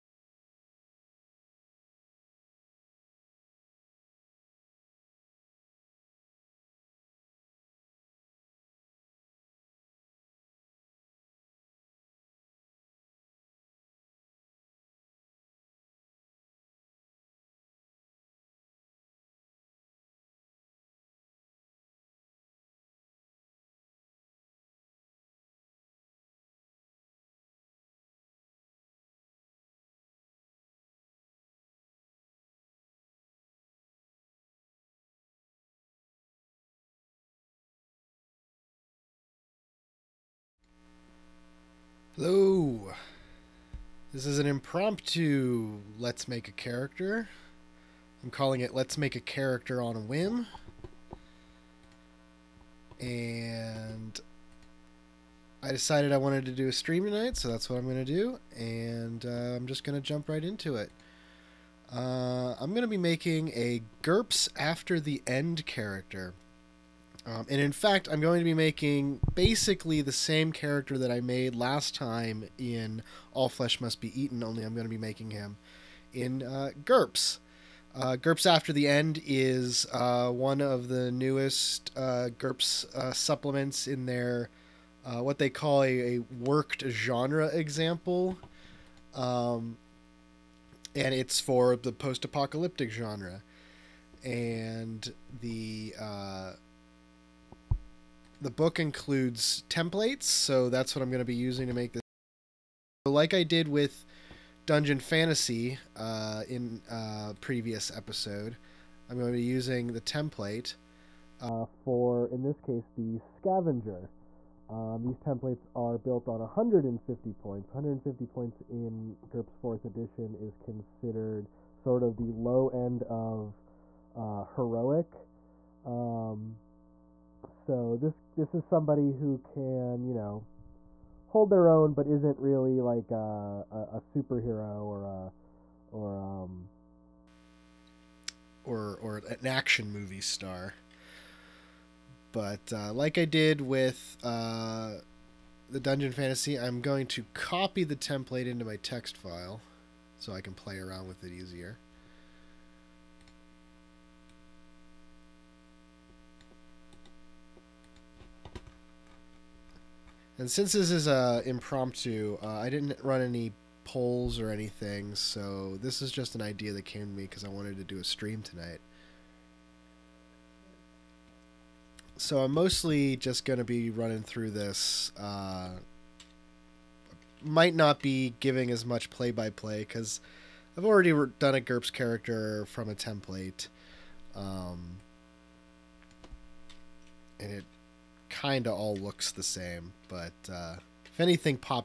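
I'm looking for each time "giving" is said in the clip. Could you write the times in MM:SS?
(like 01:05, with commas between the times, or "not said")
02:58.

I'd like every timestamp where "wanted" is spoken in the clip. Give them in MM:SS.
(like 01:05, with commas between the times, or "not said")
00:56, 02:47.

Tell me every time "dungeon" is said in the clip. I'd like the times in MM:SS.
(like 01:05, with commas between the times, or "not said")
01:44, 02:25.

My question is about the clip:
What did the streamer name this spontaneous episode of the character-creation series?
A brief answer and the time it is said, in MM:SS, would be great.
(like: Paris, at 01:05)
Let's Make a Character on a Whim, at 00:48.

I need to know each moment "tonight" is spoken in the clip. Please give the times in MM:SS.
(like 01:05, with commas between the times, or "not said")
00:57, 02:48.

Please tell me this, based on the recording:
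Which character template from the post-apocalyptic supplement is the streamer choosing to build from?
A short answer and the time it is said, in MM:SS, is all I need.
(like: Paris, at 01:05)
Scavenger, at 01:53.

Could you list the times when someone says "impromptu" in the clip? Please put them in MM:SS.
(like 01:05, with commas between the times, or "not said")
00:44, 02:41.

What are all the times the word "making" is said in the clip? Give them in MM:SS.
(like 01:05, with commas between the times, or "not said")
01:02, 01:08, 01:14.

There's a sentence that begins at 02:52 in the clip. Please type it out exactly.
So I'm mostly just going to be running through this.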